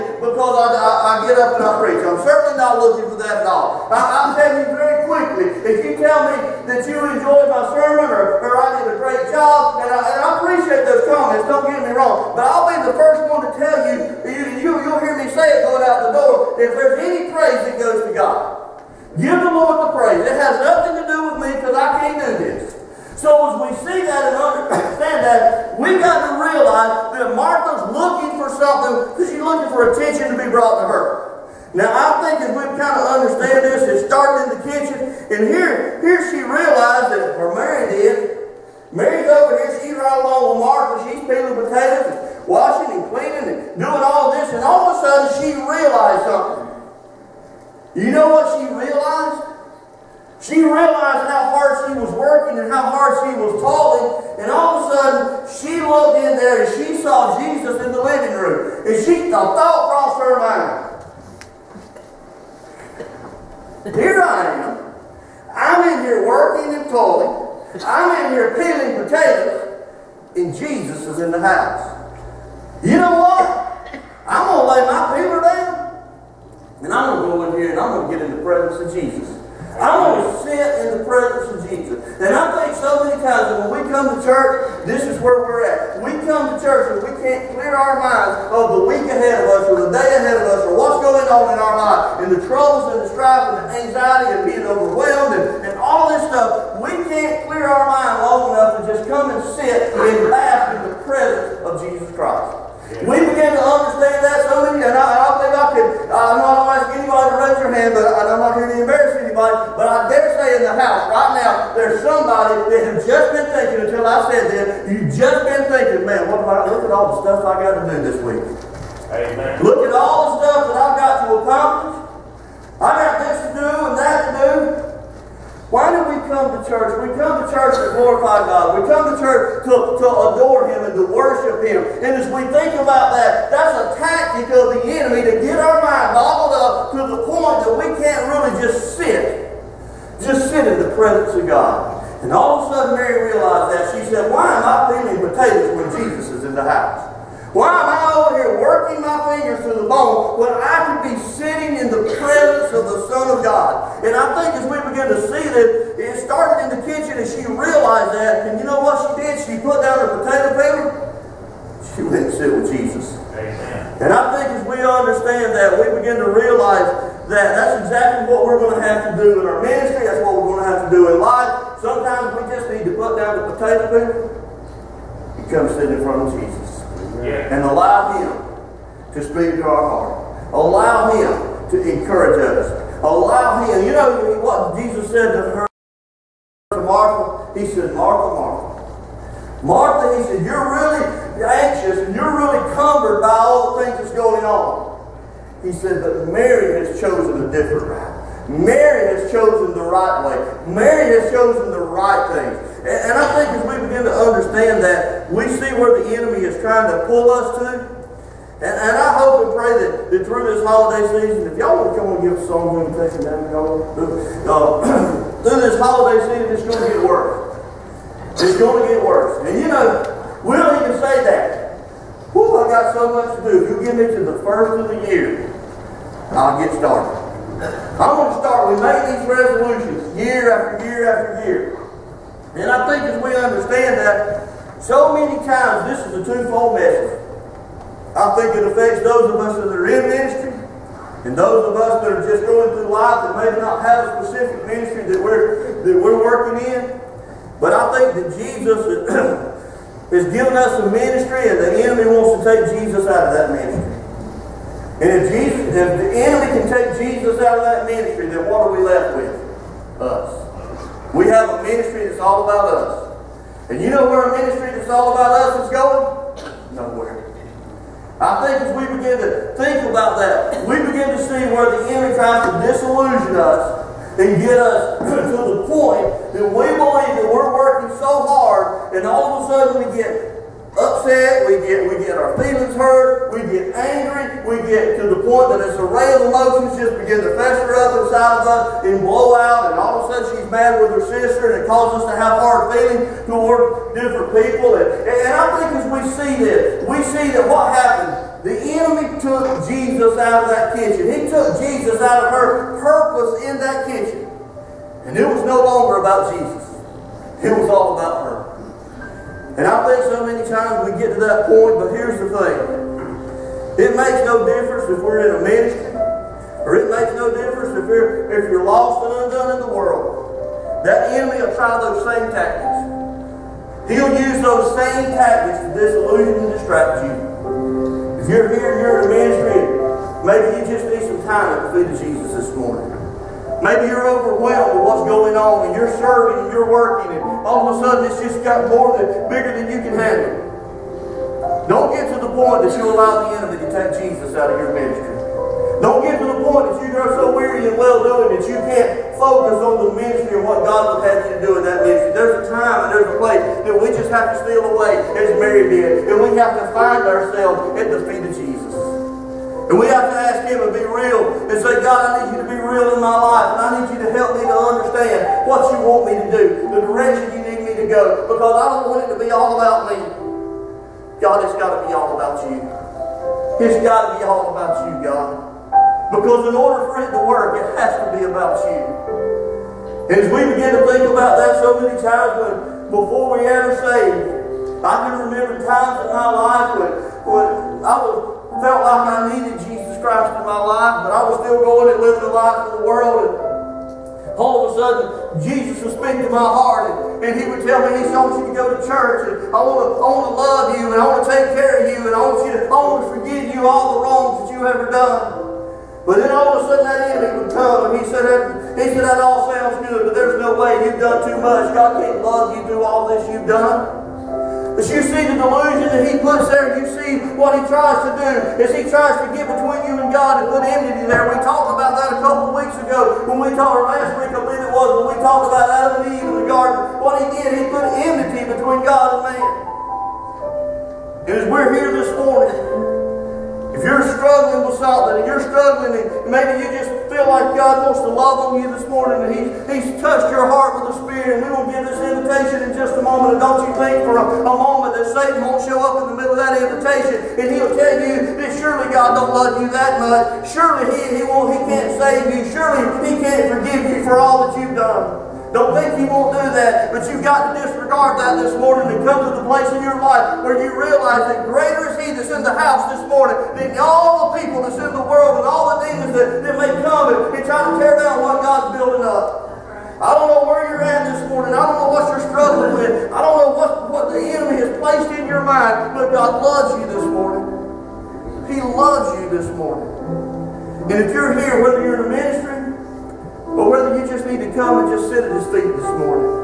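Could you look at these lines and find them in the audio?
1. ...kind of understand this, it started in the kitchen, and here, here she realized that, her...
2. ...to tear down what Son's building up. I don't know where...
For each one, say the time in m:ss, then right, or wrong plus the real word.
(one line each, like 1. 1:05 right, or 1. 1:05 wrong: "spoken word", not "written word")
1. 0:32 right
2. 7:47 wrong: "God", not "Son".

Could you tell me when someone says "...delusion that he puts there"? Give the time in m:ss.
6:55.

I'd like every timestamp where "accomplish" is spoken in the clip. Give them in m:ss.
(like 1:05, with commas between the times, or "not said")
2:01.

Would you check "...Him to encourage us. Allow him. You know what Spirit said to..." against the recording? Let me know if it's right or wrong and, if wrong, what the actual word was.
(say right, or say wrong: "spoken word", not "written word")
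wrong: "Jesus", not "Spirit".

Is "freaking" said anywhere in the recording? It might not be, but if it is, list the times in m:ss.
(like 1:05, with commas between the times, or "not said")
not said.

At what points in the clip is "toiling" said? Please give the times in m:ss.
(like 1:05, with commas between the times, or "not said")
0:53, 1:06.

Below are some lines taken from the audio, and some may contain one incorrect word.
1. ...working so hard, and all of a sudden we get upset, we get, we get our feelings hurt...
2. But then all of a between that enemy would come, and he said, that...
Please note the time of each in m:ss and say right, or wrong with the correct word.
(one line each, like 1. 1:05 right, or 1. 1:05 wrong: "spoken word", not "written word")
1. 4:37 right
2. 6:46 wrong: "sudden", not "between".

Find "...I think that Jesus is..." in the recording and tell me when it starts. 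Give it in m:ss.
4:07.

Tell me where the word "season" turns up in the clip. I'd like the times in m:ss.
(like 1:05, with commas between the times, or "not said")
3:31, 3:36.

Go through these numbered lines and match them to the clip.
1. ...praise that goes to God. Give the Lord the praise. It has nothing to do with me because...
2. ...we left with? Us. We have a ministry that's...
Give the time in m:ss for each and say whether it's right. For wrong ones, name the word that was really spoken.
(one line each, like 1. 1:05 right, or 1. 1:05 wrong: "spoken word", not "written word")
1. 0:17 right
2. 4:18 right.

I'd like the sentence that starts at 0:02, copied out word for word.
I'm certainly not looking for that at all.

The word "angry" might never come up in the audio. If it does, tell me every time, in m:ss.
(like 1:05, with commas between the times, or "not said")
4:43.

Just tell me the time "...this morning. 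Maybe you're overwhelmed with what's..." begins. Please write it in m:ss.
5:32.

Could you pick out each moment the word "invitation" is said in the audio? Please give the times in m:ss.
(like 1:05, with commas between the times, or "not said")
3:32, 7:22, 7:26.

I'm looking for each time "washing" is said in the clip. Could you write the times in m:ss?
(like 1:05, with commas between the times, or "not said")
0:42.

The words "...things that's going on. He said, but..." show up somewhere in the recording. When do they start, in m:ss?
3:13.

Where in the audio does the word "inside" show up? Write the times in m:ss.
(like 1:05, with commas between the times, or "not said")
4:47.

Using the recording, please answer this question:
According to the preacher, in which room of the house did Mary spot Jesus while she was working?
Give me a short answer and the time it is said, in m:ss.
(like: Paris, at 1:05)
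living room, at 0:58.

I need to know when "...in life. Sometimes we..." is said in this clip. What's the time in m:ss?
2:51.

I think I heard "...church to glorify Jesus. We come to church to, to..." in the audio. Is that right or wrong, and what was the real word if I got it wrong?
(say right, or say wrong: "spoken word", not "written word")
wrong: "God", not "Jesus".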